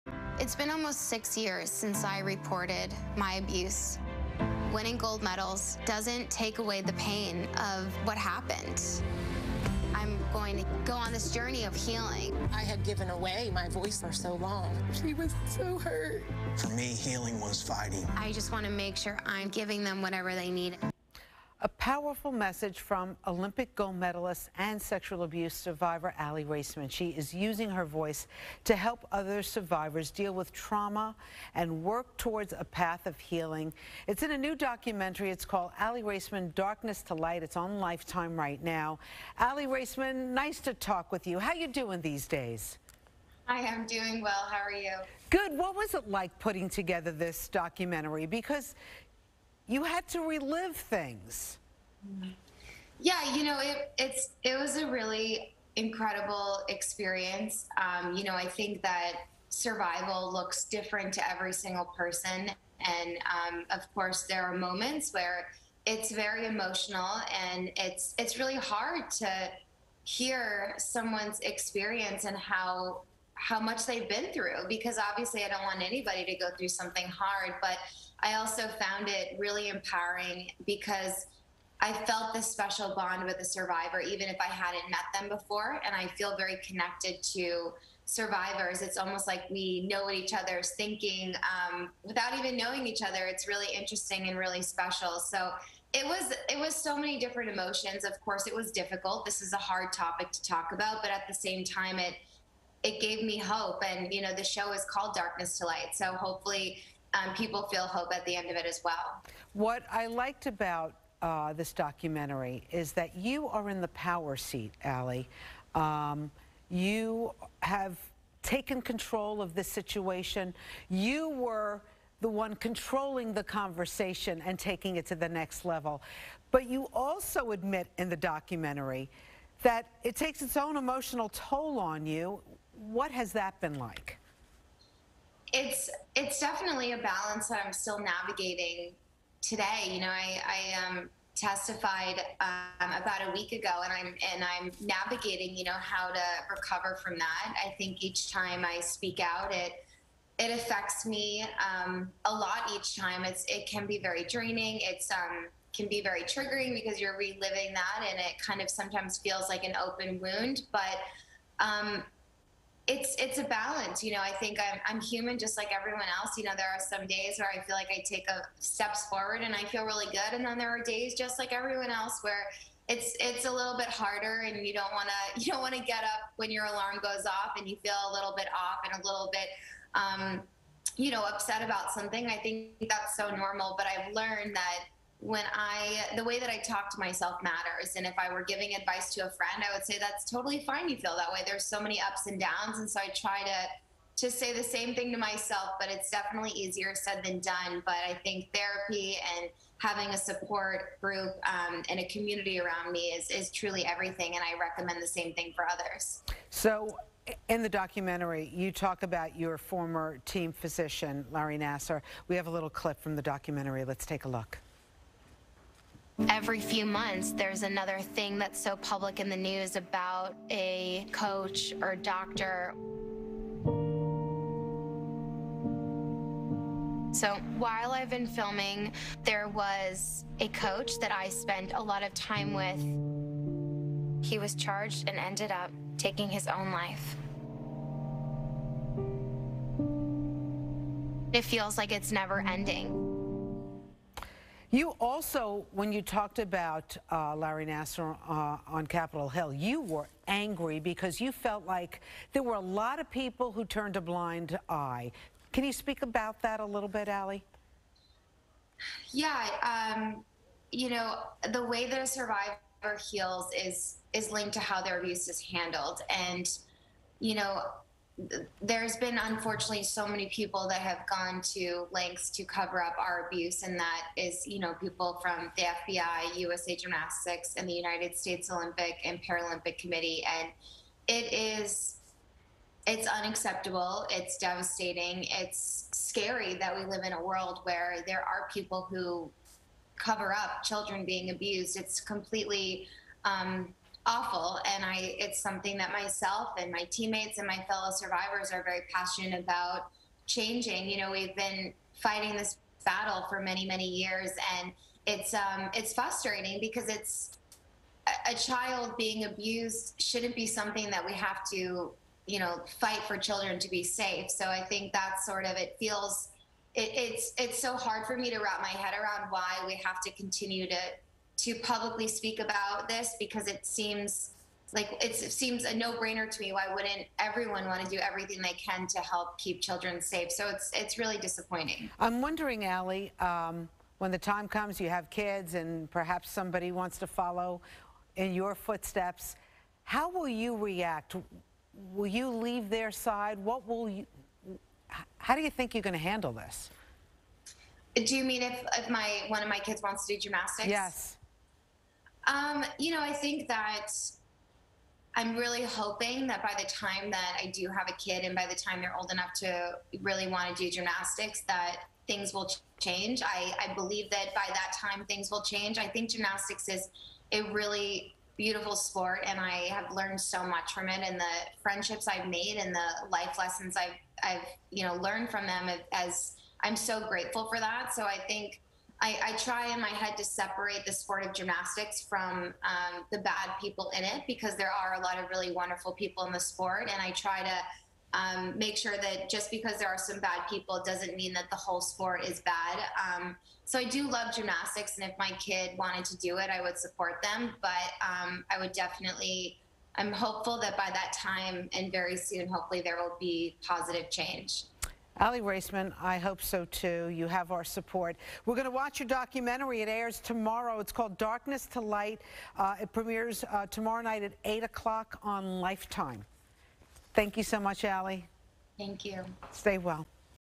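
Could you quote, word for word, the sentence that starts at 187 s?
And if I were giving advice to a friend, I would say that's totally fine.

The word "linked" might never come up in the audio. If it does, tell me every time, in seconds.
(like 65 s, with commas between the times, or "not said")
264 s.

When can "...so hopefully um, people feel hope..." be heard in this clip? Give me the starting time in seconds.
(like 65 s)
105 s.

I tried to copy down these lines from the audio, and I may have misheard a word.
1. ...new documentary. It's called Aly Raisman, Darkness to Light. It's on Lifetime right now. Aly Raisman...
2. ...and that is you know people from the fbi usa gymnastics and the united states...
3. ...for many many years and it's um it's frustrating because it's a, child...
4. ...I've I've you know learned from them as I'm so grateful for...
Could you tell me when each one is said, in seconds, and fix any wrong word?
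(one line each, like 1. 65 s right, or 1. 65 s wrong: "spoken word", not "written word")
1. 34 s right
2. 273 s right
3. 303 s right
4. 373 s right.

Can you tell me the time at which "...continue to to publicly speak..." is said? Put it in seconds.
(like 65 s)
320 s.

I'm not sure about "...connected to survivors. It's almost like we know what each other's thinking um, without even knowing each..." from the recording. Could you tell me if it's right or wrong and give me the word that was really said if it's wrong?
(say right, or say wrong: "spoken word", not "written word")
right.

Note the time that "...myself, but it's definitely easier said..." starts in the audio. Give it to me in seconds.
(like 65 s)
195 s.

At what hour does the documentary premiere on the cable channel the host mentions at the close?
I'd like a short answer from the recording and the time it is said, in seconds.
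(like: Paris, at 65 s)
8 o'clock, at 414 s.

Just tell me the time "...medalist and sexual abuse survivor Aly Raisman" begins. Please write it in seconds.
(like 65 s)
23 s.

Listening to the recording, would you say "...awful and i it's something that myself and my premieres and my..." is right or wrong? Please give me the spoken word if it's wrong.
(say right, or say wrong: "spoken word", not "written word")
wrong: "teammates", not "premieres".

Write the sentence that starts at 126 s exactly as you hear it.
But you also admit in the documentary that it takes its own emotional toll on you.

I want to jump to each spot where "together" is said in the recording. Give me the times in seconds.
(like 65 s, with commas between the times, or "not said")
46 s.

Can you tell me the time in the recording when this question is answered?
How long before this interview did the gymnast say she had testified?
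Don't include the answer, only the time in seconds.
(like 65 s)
143 s.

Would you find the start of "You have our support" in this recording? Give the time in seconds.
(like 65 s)
407 s.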